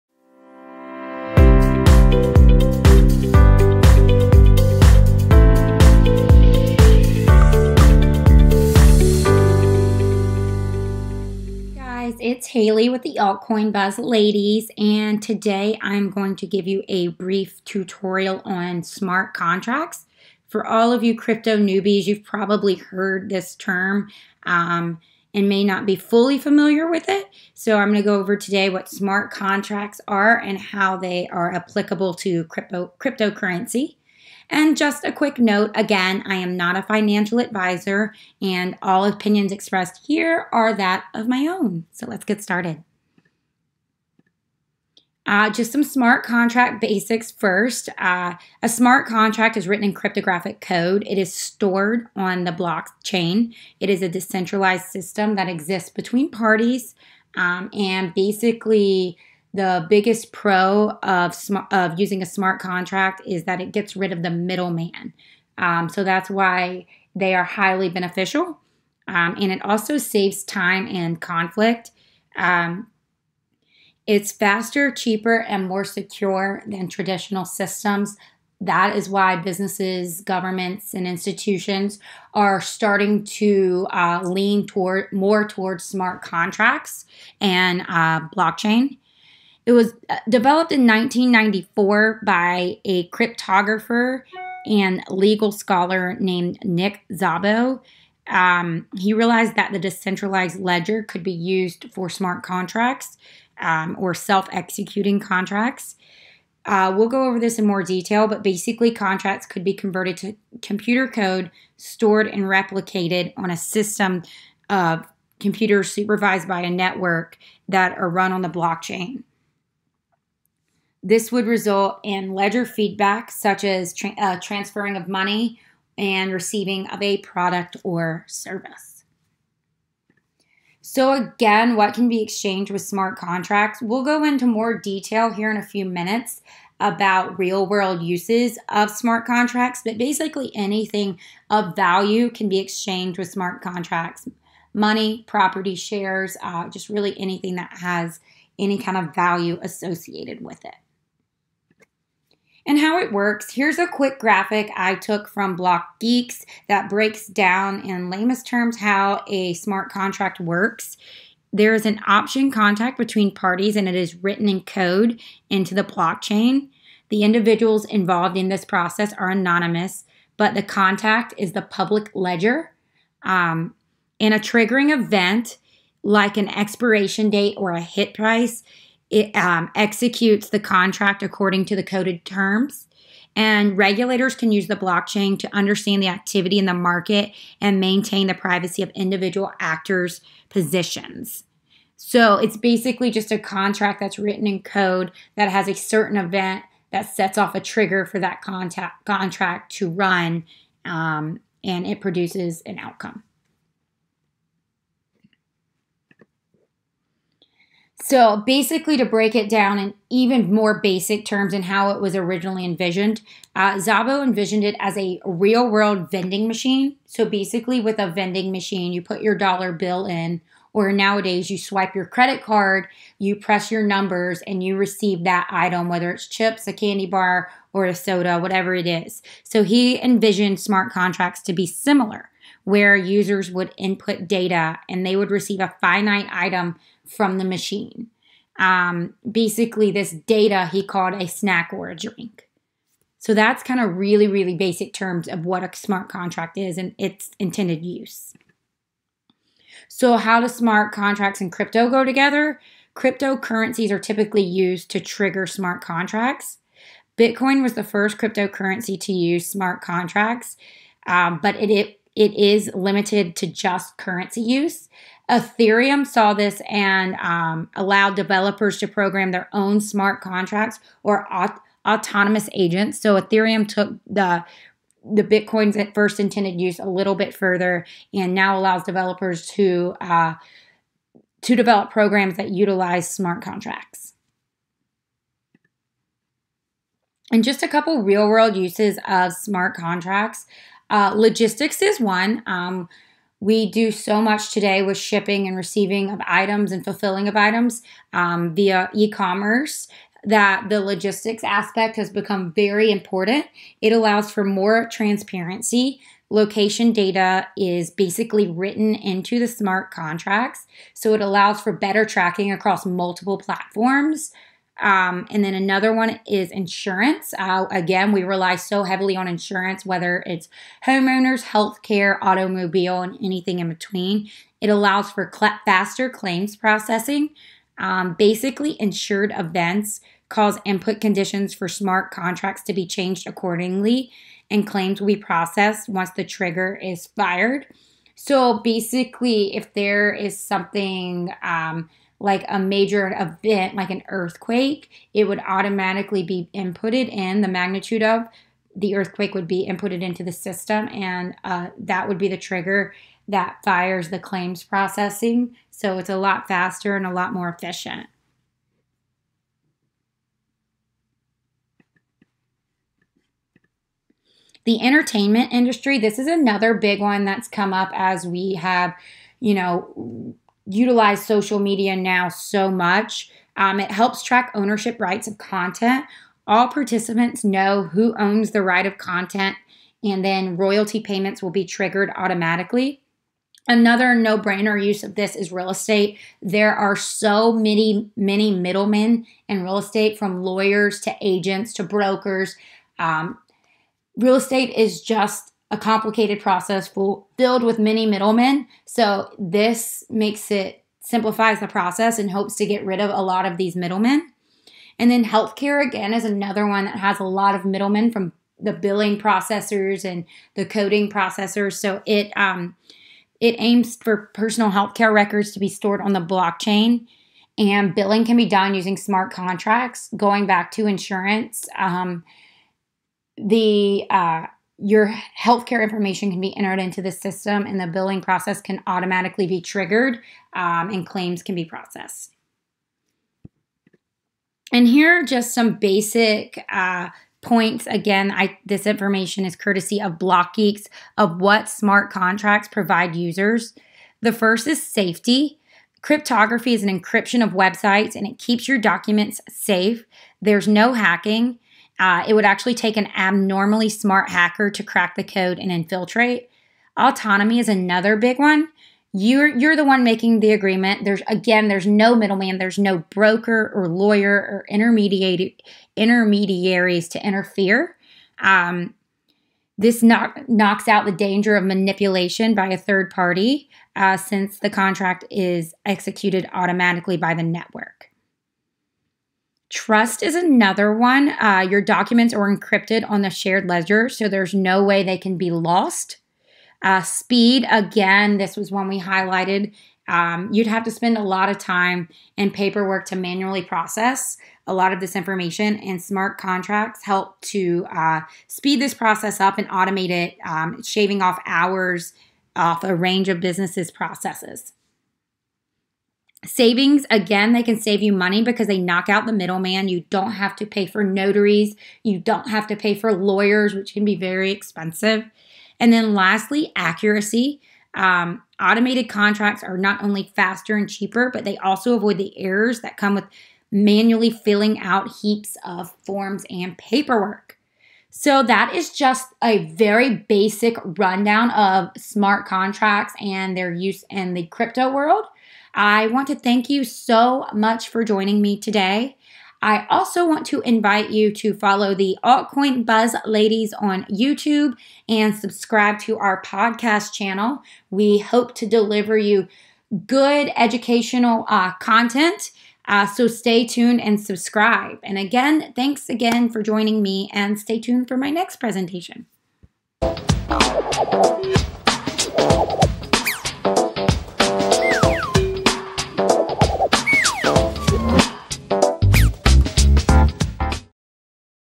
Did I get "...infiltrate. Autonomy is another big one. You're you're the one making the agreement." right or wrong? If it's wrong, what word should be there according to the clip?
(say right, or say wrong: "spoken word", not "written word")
right.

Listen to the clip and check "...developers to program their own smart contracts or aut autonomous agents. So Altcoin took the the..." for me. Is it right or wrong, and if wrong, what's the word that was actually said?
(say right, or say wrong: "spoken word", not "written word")
wrong: "Ethereum", not "Altcoin".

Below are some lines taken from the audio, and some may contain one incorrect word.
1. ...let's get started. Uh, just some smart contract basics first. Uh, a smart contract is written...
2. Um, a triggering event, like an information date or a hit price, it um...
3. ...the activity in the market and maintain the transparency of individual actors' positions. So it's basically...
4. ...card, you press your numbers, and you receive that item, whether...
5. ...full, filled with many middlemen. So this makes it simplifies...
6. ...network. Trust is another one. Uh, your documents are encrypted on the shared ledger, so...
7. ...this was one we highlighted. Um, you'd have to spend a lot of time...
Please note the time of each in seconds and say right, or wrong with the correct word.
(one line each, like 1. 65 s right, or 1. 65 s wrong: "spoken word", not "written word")
1. 42 s right
2. 173 s wrong: "expiration", not "information"
3. 186 s wrong: "privacy", not "transparency"
4. 222 s right
5. 396 s right
6. 477 s right
7. 488 s right.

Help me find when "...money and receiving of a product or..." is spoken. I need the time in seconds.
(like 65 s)
125 s.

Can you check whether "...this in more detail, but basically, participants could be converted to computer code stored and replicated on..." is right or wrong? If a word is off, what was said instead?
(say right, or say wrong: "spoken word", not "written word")
wrong: "contracts", not "participants".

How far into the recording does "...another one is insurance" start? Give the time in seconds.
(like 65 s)
315 s.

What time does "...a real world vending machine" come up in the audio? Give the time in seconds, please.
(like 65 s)
214 s.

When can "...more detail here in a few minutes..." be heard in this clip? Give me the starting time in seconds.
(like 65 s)
134 s.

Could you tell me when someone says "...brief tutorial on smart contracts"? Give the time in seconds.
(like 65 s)
17 s.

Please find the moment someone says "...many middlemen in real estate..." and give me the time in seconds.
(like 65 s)
388 s.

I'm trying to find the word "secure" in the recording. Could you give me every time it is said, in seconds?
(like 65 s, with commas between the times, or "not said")
75 s.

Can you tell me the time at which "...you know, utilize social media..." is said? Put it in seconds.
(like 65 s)
369 s.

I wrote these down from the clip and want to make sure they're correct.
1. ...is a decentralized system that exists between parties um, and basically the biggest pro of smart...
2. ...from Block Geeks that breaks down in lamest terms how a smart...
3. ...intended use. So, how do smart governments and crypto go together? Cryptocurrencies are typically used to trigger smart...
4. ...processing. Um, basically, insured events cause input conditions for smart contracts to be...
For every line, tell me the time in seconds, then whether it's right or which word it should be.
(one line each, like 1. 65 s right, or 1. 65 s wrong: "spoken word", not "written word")
1. 53 s right
2. 155 s right
3. 247 s wrong: "contracts", not "governments"
4. 326 s right.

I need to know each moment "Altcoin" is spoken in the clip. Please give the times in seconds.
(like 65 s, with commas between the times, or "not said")
13 s, 542 s.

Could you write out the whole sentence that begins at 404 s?
And then healthcare again is another one that has a lot of middlemen from the billing processors and the coding processors.